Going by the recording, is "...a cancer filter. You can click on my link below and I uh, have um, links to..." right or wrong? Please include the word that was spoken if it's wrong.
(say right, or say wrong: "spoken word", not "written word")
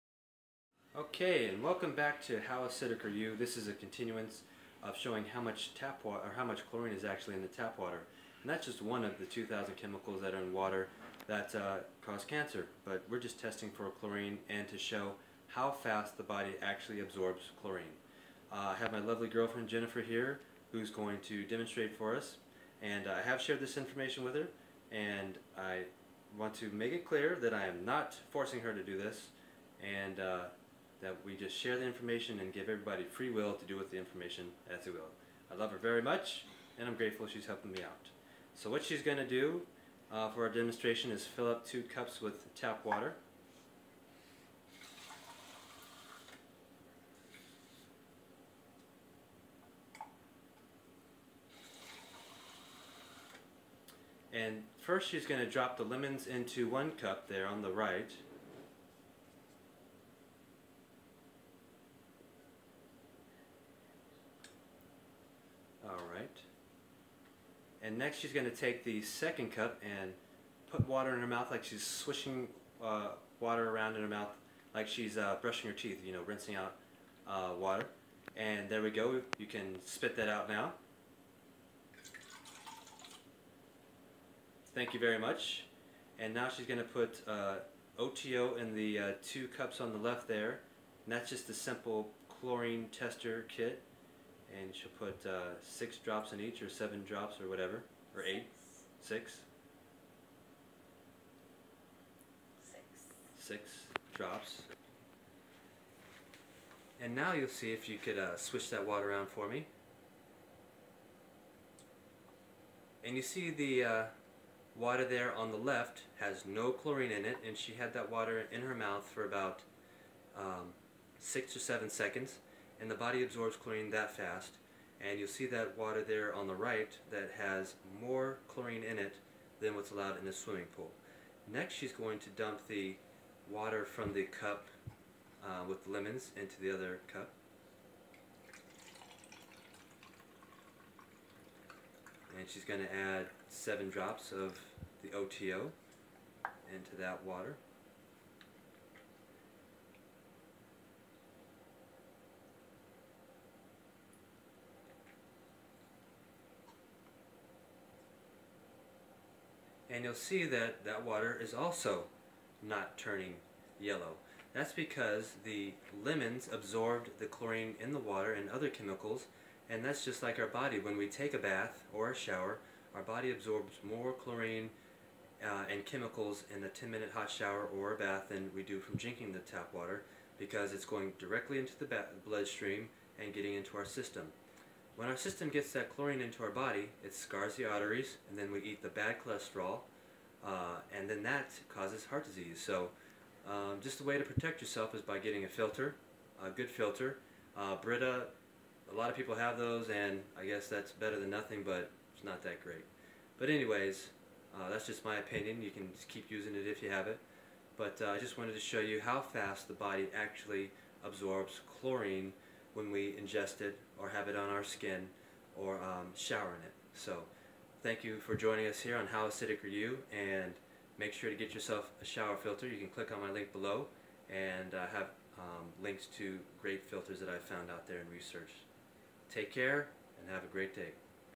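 wrong: "shower", not "cancer".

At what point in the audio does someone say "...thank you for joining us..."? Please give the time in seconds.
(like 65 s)
217 s.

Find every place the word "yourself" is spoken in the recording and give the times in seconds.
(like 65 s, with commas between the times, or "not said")
194 s, 221 s.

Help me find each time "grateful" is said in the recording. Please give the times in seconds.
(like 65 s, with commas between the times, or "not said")
36 s.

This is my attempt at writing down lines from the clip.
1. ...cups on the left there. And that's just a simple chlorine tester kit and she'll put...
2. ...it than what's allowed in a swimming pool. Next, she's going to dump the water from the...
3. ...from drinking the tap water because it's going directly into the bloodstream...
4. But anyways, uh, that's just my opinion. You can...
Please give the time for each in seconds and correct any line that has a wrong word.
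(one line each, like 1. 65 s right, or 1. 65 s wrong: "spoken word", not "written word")
1. 89 s right
2. 128 s right
3. 178 s right
4. 203 s right.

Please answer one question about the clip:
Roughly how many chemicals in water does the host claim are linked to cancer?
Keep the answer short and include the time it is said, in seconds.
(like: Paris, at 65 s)
2,000, at 9 s.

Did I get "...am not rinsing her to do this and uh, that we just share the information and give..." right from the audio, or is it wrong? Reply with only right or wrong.
wrong.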